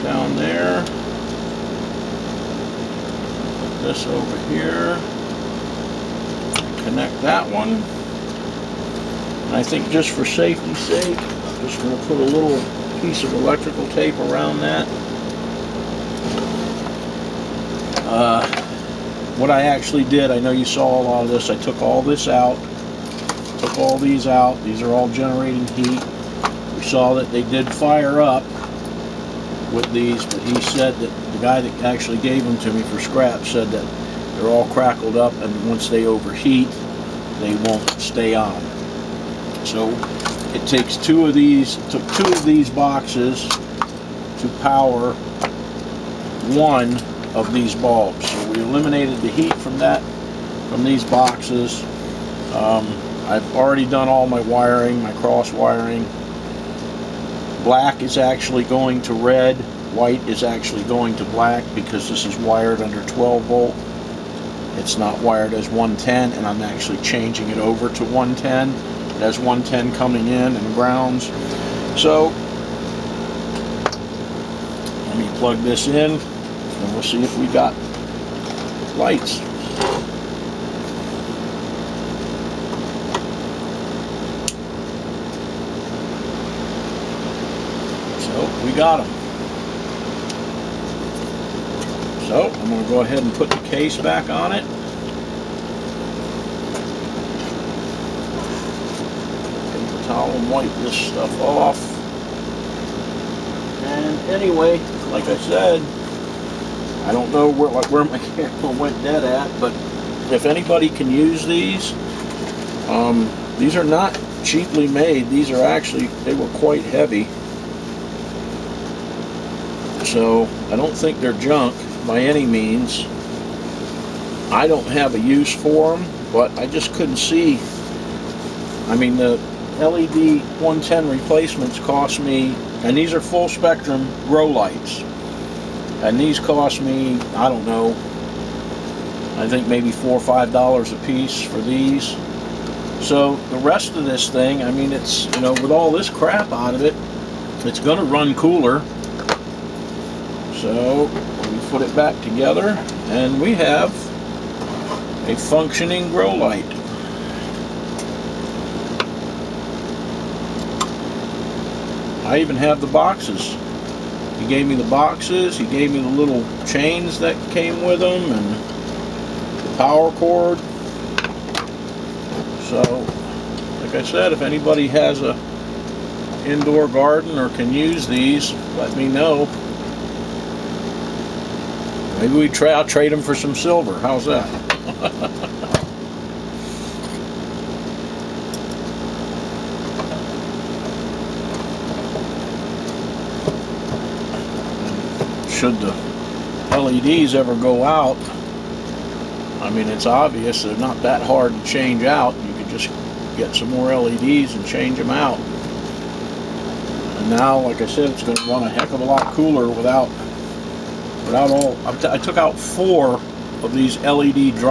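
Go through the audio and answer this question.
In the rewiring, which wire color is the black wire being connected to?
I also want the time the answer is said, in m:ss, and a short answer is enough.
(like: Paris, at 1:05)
red, at 0:59.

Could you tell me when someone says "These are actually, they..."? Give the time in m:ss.
1:55.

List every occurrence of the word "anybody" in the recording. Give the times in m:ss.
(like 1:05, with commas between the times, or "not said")
1:50, 2:54.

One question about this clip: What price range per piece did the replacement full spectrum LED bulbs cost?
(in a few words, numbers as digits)
4 or 5 dollars.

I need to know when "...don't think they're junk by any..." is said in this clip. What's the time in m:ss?
2:00.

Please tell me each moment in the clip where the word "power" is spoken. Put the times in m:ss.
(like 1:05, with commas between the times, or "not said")
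0:44, 2:49.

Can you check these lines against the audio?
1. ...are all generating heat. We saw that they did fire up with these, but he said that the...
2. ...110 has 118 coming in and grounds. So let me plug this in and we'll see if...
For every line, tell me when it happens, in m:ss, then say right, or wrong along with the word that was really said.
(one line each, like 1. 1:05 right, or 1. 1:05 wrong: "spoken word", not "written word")
1. 0:24 right
2. 1:08 wrong: "110", not "118".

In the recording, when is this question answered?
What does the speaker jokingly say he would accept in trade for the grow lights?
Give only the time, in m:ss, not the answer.
3:03.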